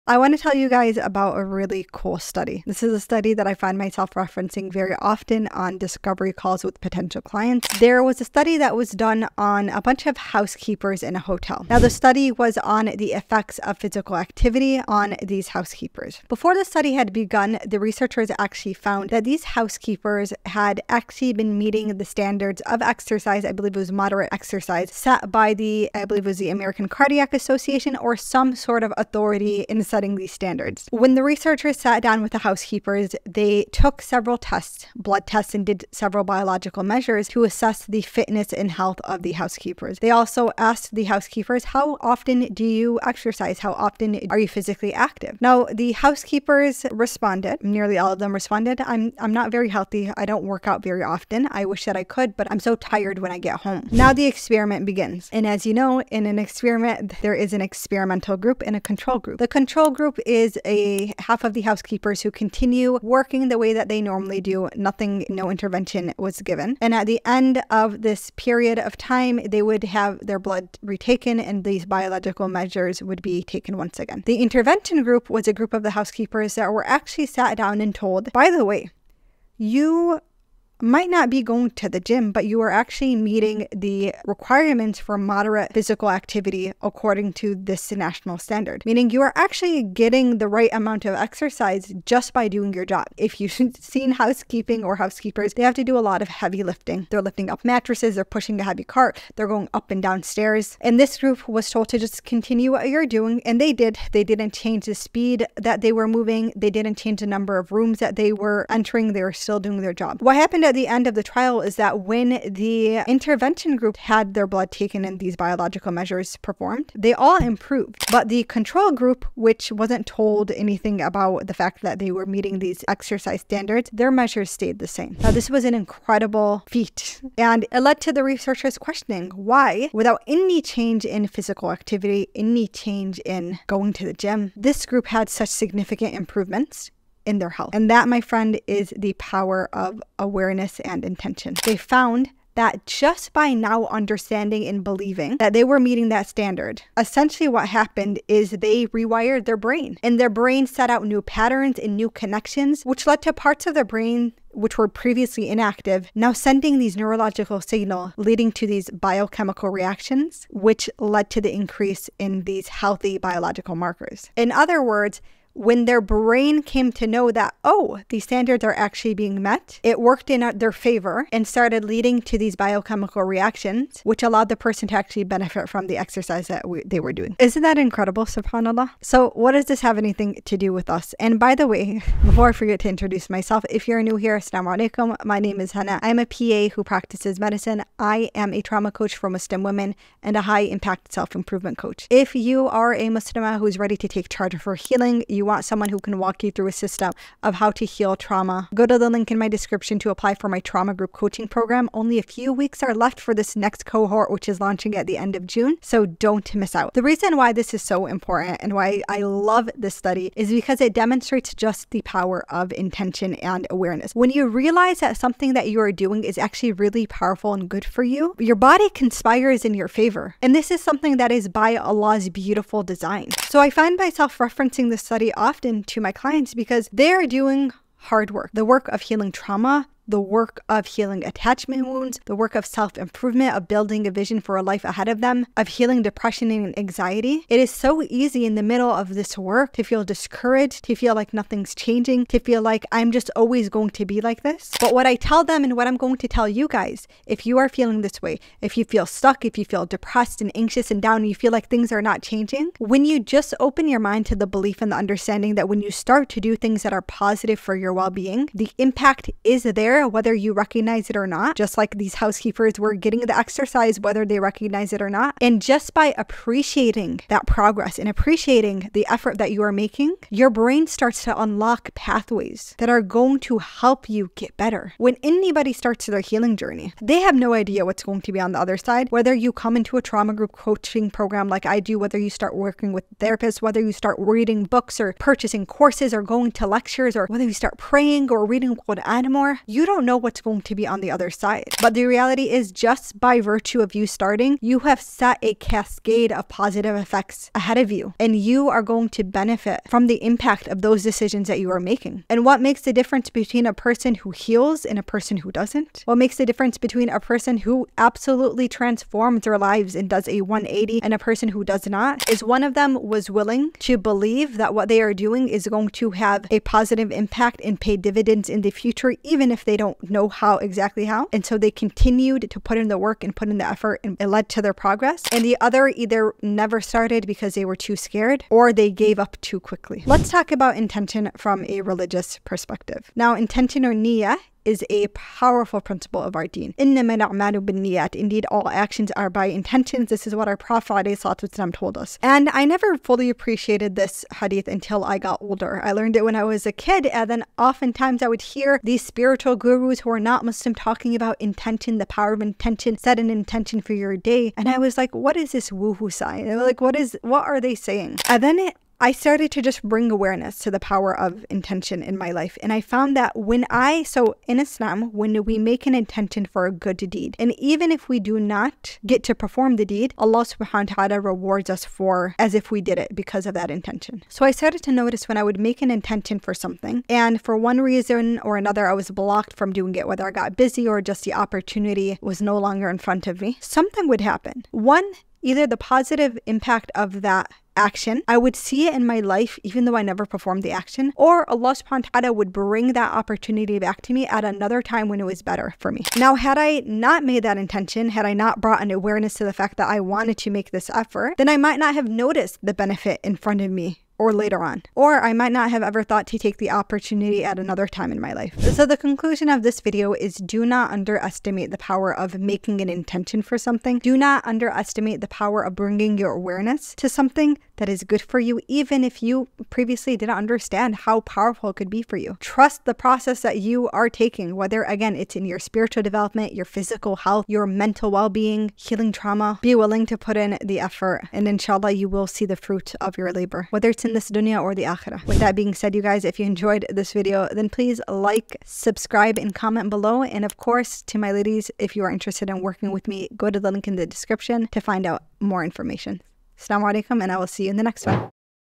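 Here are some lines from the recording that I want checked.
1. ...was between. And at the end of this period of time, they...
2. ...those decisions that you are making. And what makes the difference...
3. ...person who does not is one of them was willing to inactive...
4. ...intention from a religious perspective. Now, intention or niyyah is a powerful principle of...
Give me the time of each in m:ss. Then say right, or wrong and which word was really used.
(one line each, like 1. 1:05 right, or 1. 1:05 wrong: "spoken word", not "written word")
1. 1:06 wrong: "given", not "between"
2. 5:00 right
3. 5:11 wrong: "believe", not "inactive"
4. 5:30 right.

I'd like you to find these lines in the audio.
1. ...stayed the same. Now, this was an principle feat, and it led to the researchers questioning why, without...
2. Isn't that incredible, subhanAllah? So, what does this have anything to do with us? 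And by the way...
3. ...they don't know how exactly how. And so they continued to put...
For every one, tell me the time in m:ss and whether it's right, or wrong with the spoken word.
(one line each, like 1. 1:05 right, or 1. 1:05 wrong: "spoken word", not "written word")
1. 2:04 wrong: "incredible", not "principle"
2. 2:57 right
3. 5:19 right.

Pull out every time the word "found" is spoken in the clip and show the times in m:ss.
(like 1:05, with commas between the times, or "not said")
0:18, 2:21, 6:02.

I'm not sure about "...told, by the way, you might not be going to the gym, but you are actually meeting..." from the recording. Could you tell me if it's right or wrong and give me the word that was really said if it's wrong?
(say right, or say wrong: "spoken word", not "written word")
right.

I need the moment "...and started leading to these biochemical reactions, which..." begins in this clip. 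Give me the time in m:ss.
2:51.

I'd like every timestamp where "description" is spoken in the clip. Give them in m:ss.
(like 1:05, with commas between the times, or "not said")
3:19, 7:24.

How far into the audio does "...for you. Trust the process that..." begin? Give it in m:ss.
7:02.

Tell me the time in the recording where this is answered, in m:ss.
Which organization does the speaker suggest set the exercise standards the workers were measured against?
0:26.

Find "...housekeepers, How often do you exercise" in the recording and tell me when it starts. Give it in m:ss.
0:41.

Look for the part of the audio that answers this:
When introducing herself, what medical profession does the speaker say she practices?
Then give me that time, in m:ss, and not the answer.
3:06.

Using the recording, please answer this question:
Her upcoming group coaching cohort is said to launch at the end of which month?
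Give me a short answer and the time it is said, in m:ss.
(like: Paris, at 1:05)
June, at 3:25.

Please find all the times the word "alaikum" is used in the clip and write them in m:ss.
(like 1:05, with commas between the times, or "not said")
3:04, 7:26.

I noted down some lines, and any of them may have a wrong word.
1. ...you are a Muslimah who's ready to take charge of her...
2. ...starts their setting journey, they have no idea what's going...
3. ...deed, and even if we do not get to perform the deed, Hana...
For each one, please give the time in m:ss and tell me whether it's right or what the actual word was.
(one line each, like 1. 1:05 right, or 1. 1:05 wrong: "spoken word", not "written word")
1. 3:12 right
2. 4:35 wrong: "healing", not "setting"
3. 6:06 wrong: "Allah", not "Hana".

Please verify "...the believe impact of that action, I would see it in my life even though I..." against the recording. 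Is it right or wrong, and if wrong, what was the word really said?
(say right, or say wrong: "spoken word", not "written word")
wrong: "positive", not "believe".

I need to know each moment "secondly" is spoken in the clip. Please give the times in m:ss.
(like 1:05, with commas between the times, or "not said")
not said.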